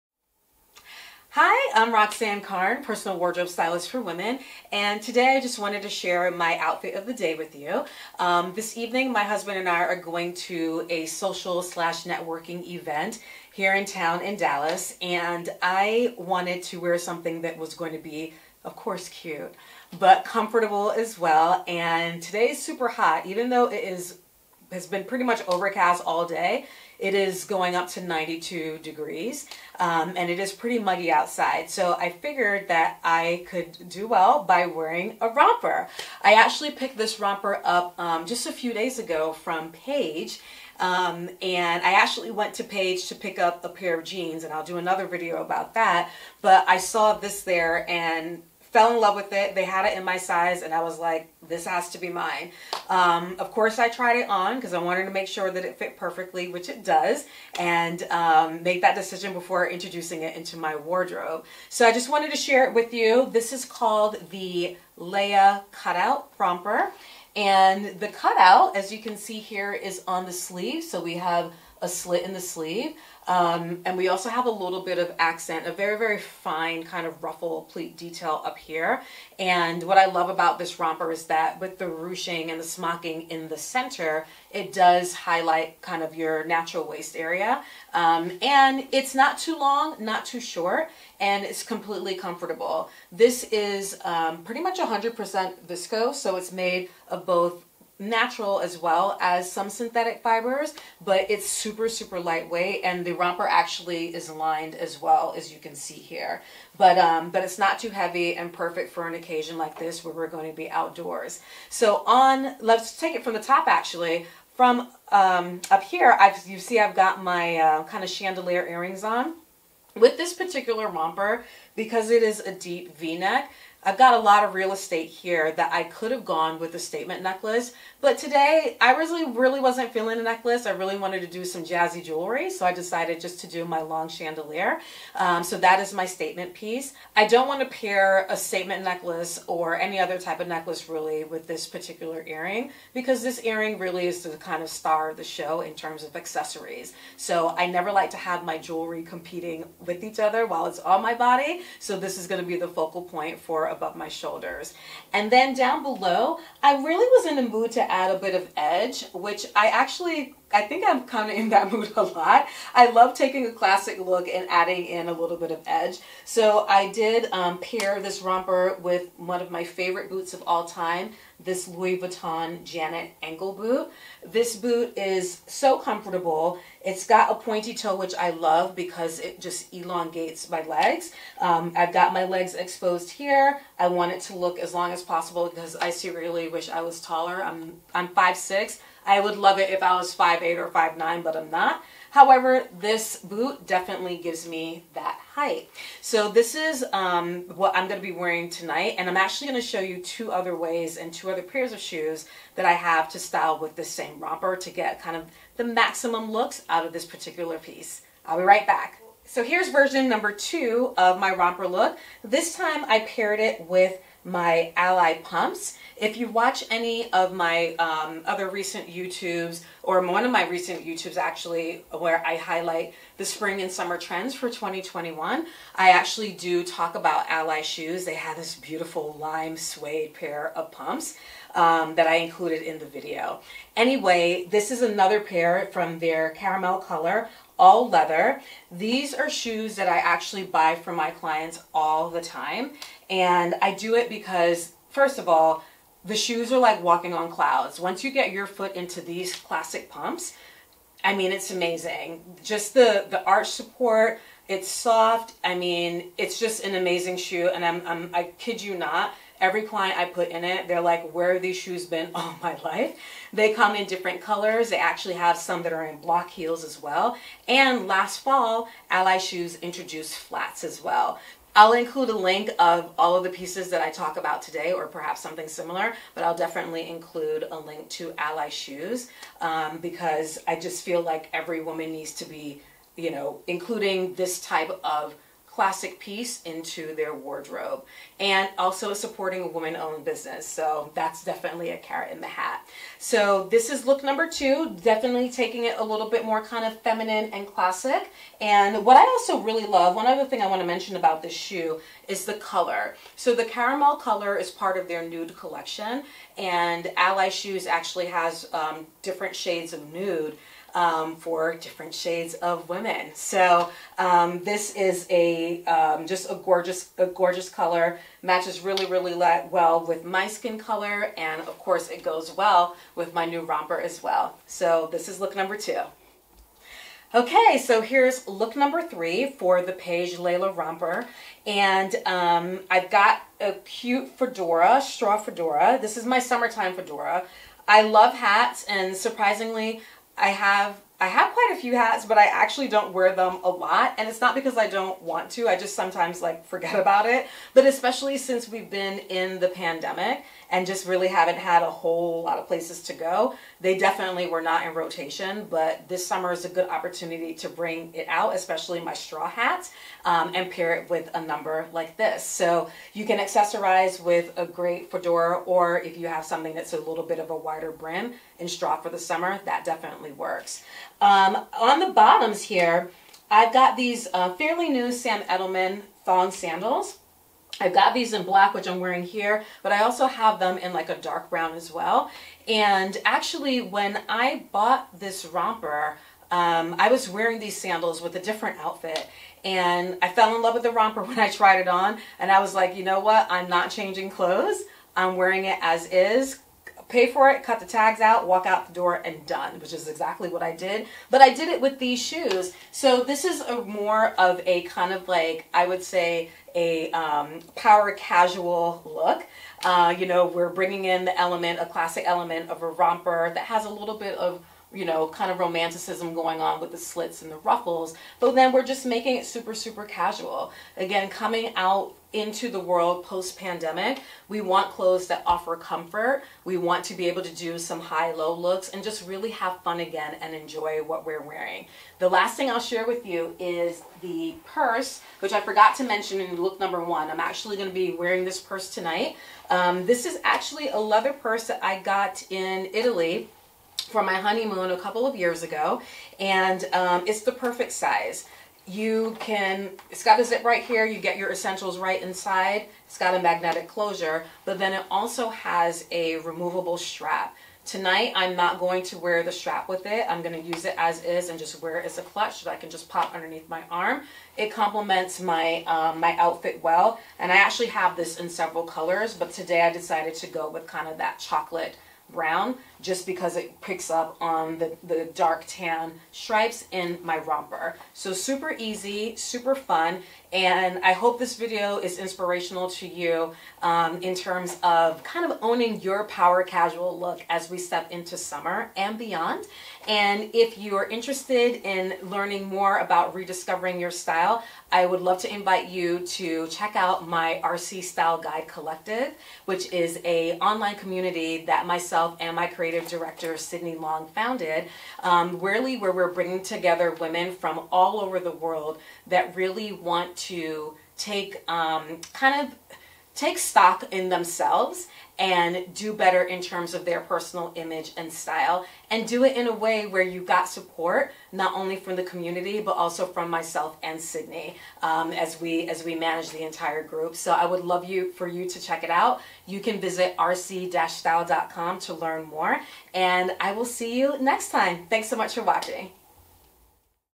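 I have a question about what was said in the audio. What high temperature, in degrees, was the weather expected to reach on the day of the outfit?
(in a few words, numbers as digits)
92.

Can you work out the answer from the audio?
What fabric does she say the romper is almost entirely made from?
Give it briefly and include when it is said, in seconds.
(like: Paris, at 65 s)
viscose, at 95 s.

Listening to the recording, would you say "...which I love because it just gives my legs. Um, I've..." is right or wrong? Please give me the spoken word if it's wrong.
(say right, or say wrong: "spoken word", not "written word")
wrong: "elongates", not "gives".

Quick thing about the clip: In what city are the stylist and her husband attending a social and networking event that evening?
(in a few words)
Dallas.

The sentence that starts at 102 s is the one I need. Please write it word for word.
And the romper actually is lined as well, as you can see here.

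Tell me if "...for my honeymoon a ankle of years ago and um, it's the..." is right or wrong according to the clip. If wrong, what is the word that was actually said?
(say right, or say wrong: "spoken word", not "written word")
wrong: "couple", not "ankle".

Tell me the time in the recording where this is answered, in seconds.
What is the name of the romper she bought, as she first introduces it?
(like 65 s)
64 s.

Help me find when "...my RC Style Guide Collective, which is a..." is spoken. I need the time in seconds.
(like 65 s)
497 s.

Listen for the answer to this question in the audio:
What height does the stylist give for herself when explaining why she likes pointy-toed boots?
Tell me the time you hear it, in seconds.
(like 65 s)
188 s.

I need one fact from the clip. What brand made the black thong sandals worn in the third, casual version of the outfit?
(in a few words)
Sam Edelman.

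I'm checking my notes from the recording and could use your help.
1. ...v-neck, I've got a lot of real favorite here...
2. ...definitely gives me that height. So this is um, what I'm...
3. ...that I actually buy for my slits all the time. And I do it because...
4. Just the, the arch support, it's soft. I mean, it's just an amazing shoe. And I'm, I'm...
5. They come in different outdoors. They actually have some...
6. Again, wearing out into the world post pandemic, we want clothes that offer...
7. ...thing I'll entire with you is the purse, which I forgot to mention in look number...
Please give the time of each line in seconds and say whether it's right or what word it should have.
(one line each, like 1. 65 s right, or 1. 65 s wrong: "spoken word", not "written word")
1. 122 s wrong: "estate", not "favorite"
2. 193 s right
3. 239 s wrong: "clients", not "slits"
4. 252 s right
5. 263 s wrong: "colors", not "outdoors"
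6. 420 s wrong: "coming", not "wearing"
7. 432 s wrong: "share", not "entire".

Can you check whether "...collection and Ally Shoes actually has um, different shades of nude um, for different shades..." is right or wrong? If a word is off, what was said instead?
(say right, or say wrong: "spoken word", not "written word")
right.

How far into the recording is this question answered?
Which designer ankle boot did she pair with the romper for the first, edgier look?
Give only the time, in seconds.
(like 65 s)
171 s.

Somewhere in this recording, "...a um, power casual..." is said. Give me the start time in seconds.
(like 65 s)
406 s.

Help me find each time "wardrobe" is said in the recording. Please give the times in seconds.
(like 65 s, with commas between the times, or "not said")
3 s, 60 s, 287 s.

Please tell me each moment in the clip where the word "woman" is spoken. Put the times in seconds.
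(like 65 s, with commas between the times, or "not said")
281 s, 289 s.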